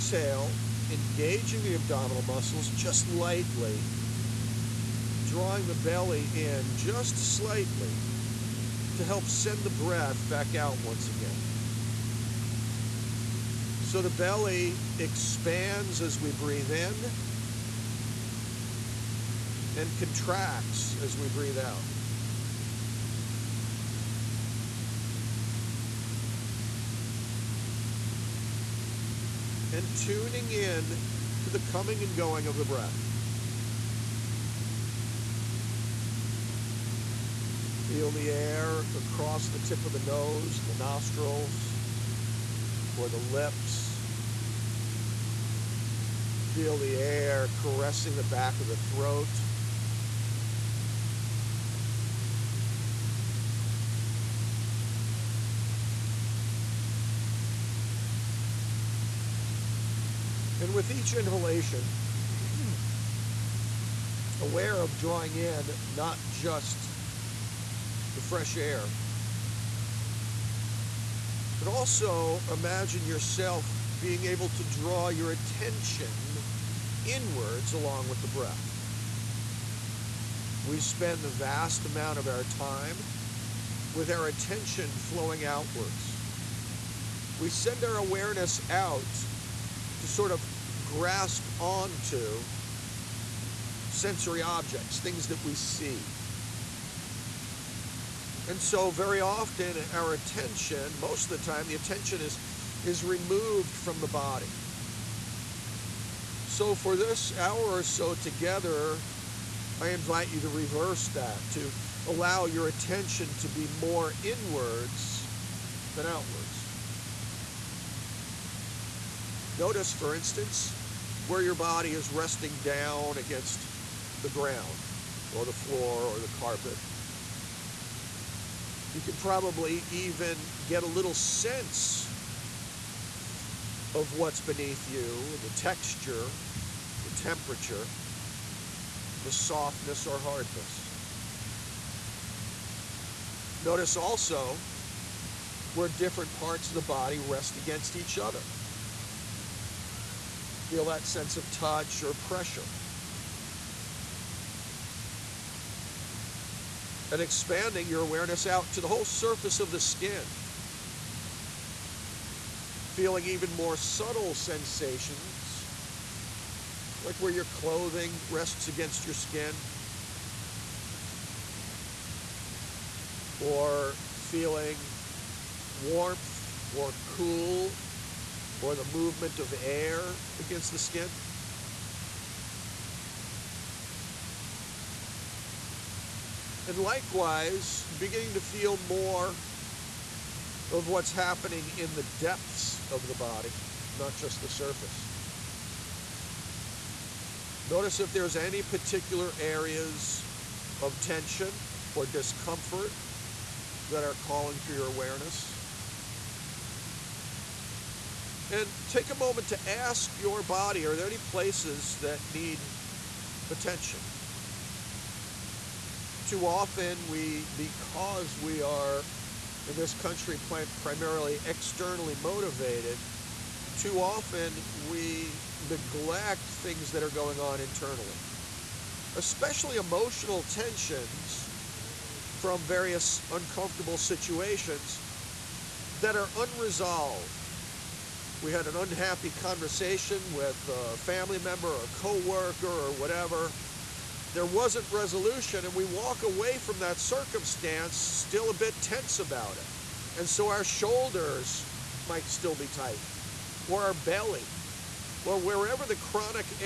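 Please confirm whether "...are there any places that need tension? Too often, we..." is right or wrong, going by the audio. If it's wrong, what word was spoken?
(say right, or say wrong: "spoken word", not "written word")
wrong: "attention", not "tension".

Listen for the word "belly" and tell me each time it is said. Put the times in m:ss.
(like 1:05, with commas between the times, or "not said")
0:05, 0:14, 4:13.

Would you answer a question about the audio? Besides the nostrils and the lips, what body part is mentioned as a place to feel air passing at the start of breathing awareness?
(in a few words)
tip of the nose.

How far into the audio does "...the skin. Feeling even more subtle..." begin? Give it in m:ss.
2:39.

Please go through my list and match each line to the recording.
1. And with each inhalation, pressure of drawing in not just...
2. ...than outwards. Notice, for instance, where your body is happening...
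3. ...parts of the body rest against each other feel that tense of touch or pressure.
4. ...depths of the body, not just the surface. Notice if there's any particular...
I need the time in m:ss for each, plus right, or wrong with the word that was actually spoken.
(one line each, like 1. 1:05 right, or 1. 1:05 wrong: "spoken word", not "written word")
1. 1:00 wrong: "aware", not "pressure"
2. 1:55 wrong: "resting", not "happening"
3. 2:26 wrong: "sense", not "tense"
4. 3:12 right.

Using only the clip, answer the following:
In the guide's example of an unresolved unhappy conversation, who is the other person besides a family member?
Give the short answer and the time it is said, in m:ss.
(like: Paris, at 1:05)
coworker, at 4:01.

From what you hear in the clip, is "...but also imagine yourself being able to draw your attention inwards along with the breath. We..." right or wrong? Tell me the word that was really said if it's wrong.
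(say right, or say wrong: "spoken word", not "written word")
right.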